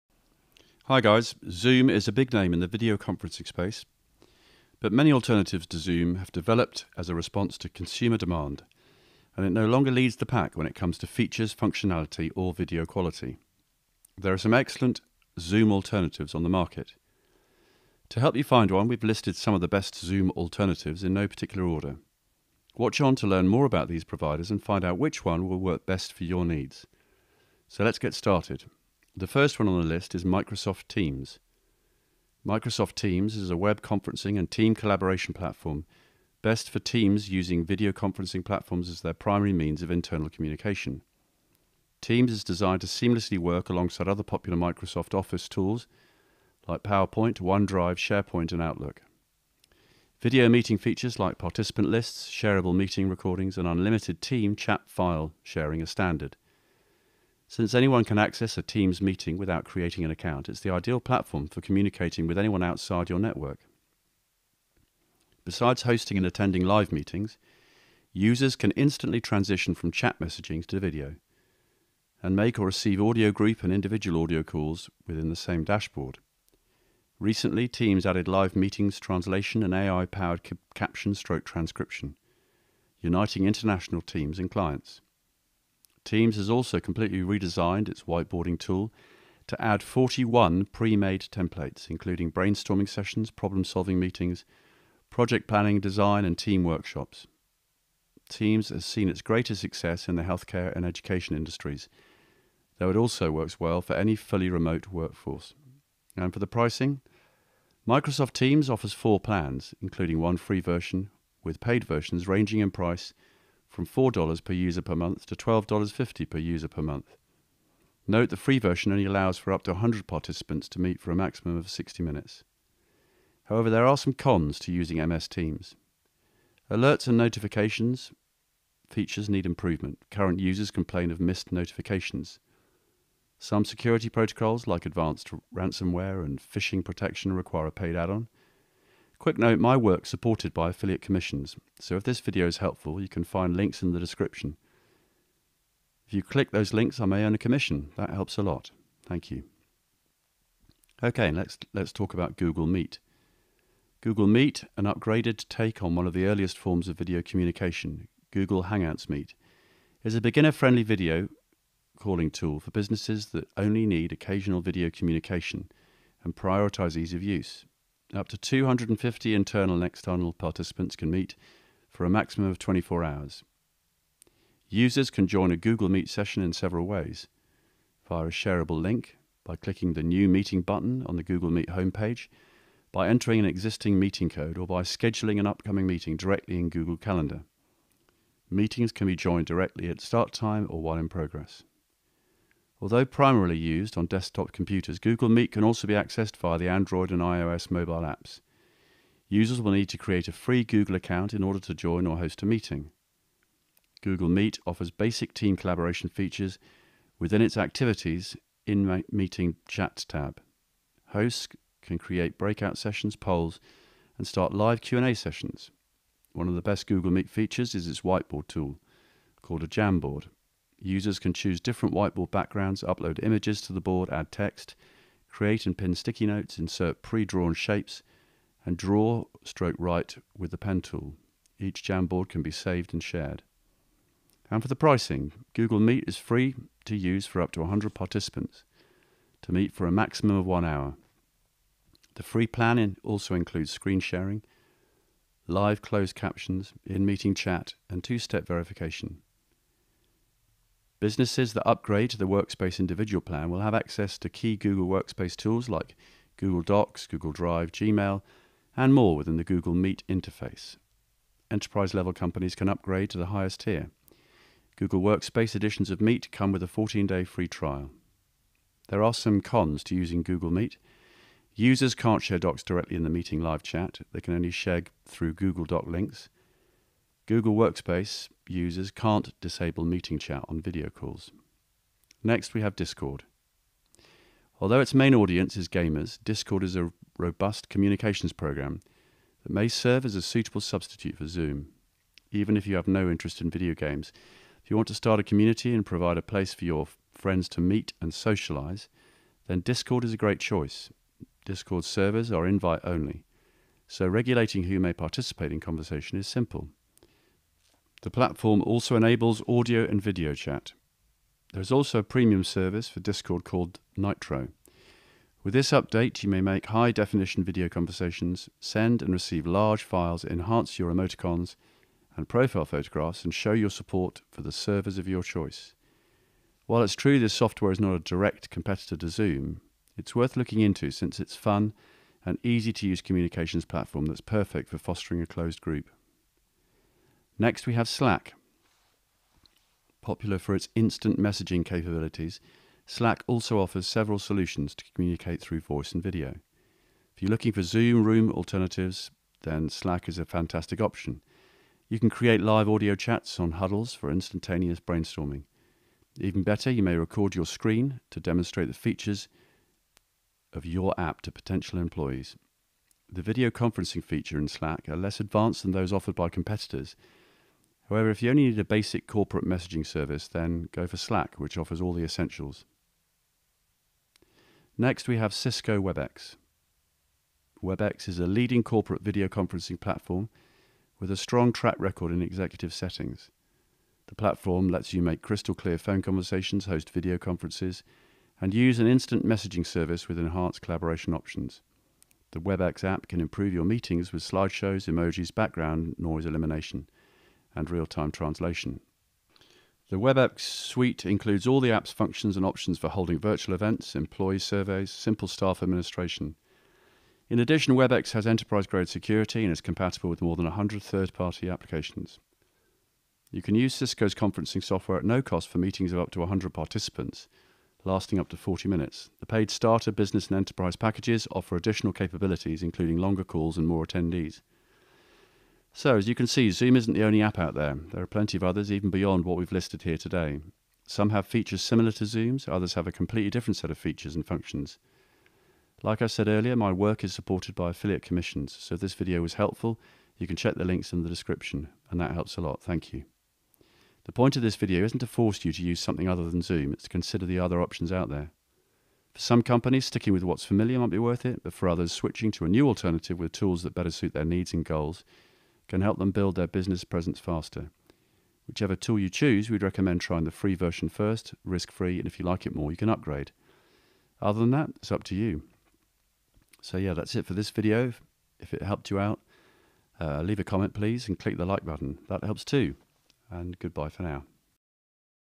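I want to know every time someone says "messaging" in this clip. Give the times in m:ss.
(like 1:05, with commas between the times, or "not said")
1:10, 5:41, 6:09, 6:29.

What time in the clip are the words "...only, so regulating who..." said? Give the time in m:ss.
5:02.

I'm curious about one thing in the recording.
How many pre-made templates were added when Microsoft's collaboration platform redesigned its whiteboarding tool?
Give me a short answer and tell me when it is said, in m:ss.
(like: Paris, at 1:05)
41, at 1:29.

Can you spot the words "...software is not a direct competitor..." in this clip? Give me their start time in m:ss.
5:27.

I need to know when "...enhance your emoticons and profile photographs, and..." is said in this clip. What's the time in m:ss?
5:20.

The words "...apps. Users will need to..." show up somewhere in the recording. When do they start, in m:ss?
3:18.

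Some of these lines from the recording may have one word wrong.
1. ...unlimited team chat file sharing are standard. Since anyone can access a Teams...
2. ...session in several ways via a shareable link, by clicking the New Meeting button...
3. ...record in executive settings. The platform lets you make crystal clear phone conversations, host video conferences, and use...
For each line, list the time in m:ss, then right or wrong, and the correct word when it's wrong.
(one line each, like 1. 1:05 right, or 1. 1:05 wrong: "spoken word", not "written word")
1. 0:53 right
2. 2:56 right
3. 6:21 right.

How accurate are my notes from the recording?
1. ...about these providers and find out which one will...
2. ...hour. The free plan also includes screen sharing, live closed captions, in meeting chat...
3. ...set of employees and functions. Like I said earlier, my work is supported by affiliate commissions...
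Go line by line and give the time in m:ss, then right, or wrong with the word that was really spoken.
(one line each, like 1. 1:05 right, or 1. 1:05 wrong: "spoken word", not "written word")
1. 0:23 right
2. 4:00 right
3. 7:13 wrong: "features", not "employees".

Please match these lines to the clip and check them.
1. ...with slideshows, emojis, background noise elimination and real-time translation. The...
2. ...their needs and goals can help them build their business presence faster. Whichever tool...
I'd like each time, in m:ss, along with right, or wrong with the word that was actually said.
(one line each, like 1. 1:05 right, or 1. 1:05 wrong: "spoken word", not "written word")
1. 6:34 right
2. 7:34 right.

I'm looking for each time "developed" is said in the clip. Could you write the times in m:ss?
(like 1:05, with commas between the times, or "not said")
0:06.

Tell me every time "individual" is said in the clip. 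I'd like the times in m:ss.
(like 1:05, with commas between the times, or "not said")
1:13, 4:12.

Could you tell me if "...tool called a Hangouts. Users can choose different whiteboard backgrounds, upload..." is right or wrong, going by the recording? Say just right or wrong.
wrong.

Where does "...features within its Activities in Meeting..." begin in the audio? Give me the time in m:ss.
3:26.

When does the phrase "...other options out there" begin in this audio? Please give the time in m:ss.
7:27.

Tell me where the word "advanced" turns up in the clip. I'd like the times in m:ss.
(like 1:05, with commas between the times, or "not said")
2:14, 6:05.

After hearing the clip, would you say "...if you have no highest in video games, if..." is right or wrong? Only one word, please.
wrong.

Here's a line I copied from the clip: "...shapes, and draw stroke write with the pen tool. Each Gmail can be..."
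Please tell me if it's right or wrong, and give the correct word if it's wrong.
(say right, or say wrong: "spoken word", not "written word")
wrong: "Jamboard", not "Gmail".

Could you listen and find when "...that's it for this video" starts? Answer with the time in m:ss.
7:46.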